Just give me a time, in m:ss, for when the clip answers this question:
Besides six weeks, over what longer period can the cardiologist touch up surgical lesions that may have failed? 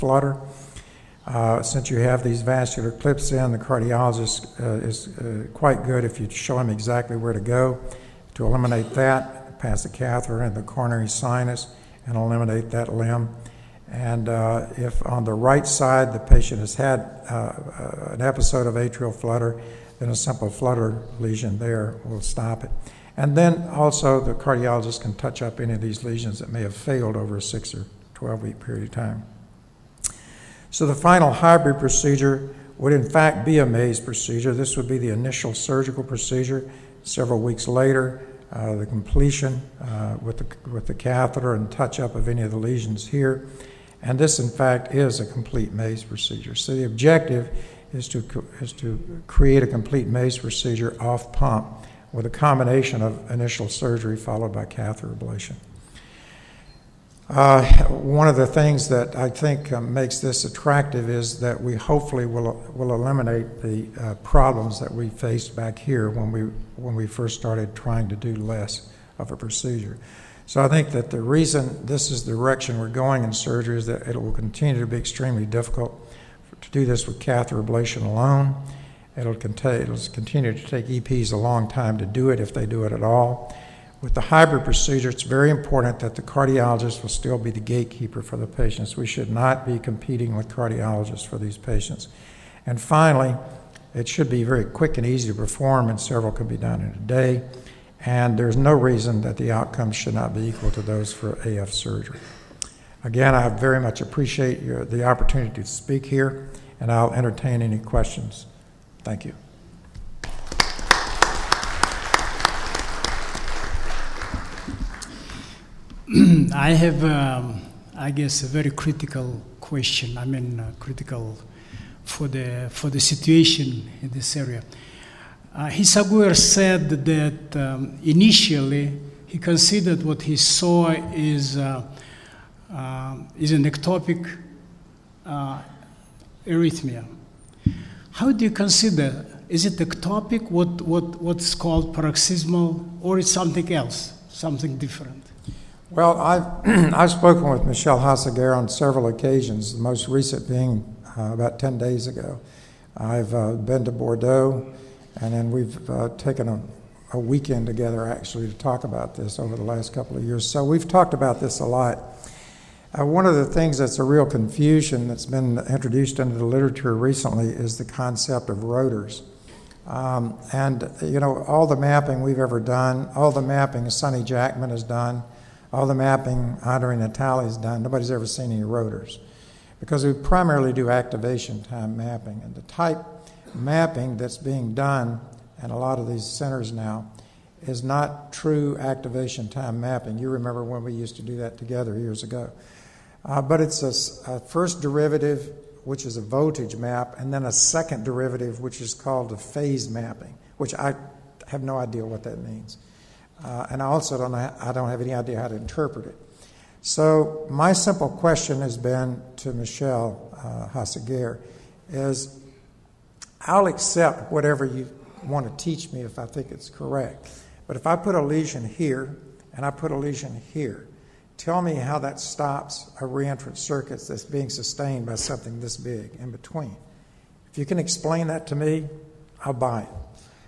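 0:28.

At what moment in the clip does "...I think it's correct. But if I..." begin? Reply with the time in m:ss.
3:36.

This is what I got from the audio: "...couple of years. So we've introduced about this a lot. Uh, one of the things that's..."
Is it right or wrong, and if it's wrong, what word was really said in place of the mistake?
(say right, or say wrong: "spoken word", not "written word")
wrong: "talked", not "introduced".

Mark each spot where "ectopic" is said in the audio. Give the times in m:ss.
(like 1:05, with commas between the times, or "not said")
2:13, 2:19.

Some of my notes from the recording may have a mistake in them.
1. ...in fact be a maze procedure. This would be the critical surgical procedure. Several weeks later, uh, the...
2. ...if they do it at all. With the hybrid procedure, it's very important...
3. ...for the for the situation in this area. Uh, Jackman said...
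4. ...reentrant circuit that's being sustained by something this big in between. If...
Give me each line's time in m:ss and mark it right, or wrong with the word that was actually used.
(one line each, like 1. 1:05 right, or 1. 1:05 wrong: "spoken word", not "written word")
1. 0:32 wrong: "initial", not "critical"
2. 1:22 right
3. 2:02 wrong: "Hisaguer", not "Jackman"
4. 3:43 right.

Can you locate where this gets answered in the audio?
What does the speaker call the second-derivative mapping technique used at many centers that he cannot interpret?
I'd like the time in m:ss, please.
3:19.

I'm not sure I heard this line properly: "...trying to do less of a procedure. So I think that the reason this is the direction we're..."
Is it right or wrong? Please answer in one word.
right.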